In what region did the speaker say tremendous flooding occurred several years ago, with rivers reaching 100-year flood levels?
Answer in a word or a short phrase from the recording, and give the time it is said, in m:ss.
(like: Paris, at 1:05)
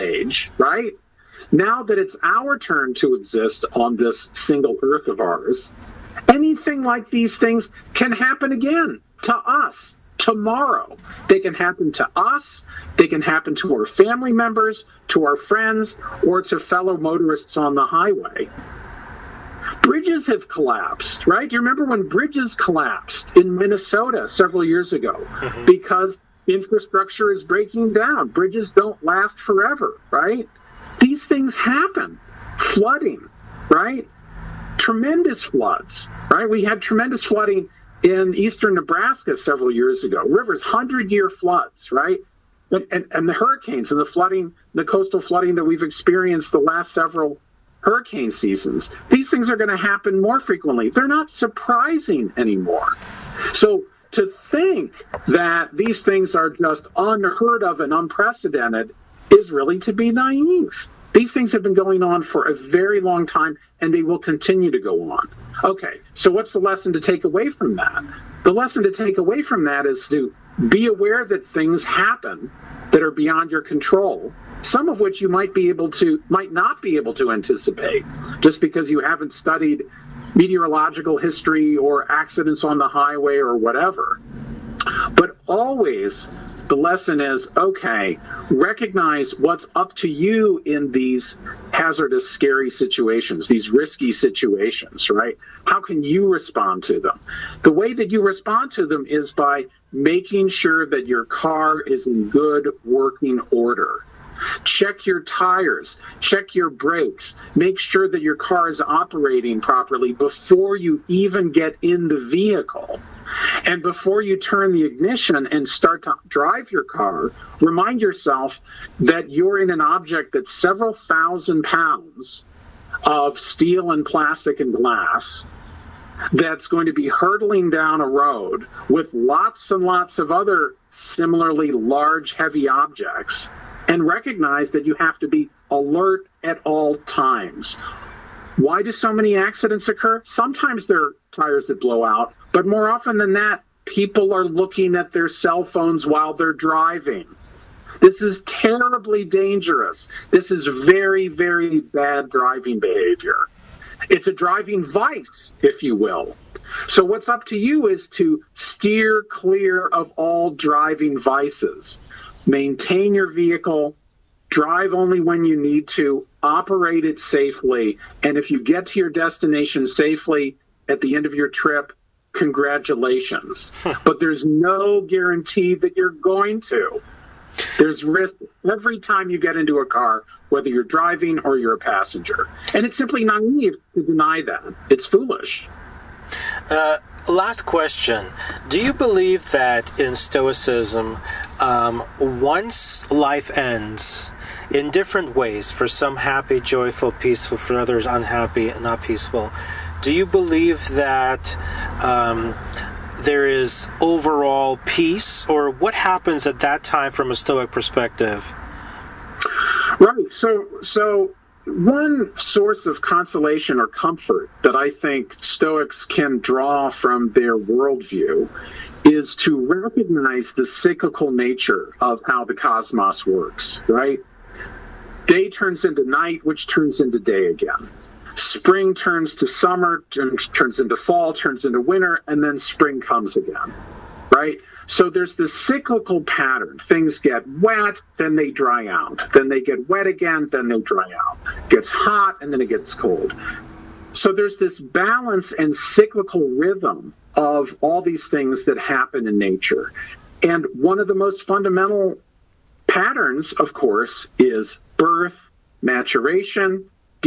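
eastern Nebraska, at 0:38.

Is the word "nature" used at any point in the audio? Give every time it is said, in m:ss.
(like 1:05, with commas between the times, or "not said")
3:41, 4:09.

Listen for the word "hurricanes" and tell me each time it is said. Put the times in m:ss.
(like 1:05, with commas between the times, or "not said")
0:43, 0:47.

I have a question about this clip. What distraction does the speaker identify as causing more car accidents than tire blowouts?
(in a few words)
cell phones.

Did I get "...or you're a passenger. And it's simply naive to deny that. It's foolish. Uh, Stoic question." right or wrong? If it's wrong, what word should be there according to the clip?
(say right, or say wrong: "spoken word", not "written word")
wrong: "Last", not "Stoic".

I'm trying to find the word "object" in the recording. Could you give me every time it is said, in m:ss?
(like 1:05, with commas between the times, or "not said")
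1:59, 2:12.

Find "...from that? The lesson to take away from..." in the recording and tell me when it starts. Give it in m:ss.
1:07.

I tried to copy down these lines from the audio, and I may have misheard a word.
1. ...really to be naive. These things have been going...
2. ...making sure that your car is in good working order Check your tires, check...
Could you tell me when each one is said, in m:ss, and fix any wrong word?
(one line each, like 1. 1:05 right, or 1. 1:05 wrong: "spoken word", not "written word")
1. 0:59 right
2. 1:39 right.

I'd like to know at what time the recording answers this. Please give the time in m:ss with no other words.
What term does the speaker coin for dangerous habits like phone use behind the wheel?
2:34.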